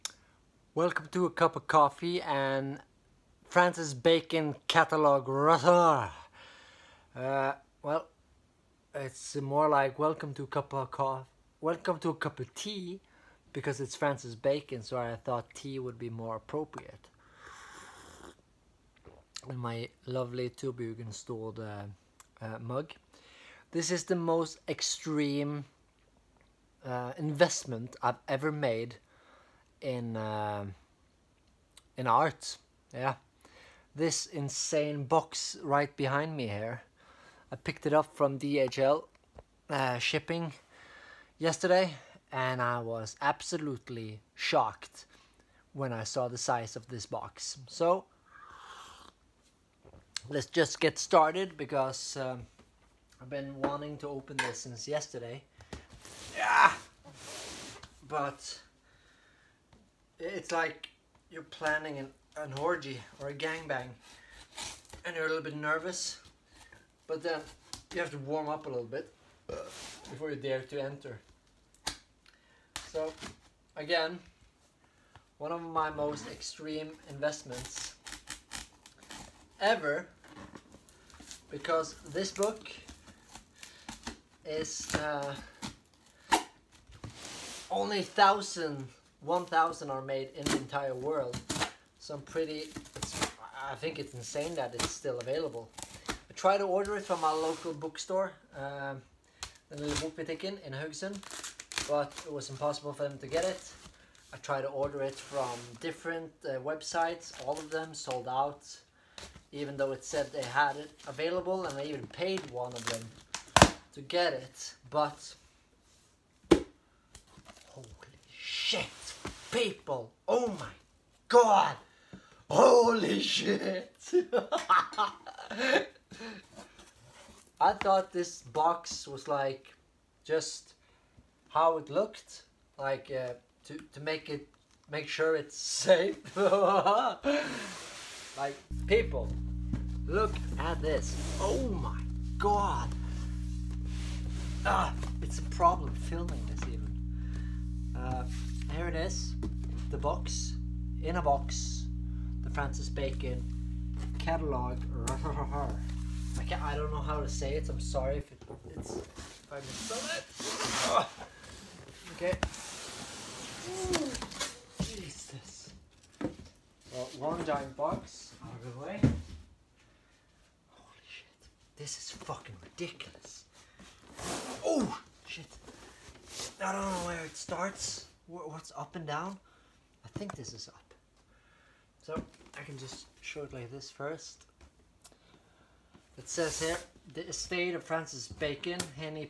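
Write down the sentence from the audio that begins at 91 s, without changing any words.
So I'm pretty, I think it's insane that it's still available.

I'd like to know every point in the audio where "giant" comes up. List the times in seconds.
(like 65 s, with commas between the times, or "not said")
167 s.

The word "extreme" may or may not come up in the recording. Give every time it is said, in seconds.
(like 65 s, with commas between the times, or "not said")
24 s, 76 s.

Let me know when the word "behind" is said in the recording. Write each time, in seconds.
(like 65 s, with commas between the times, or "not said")
35 s.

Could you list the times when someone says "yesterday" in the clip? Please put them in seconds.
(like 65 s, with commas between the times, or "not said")
41 s, 54 s.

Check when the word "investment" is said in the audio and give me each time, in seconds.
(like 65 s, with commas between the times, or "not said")
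27 s, 77 s.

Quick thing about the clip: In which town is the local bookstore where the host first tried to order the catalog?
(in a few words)
Haugesund.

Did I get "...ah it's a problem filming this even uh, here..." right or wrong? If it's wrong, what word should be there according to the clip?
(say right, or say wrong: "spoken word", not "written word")
right.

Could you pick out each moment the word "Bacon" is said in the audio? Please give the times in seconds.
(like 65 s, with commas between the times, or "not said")
3 s, 14 s, 152 s, 188 s.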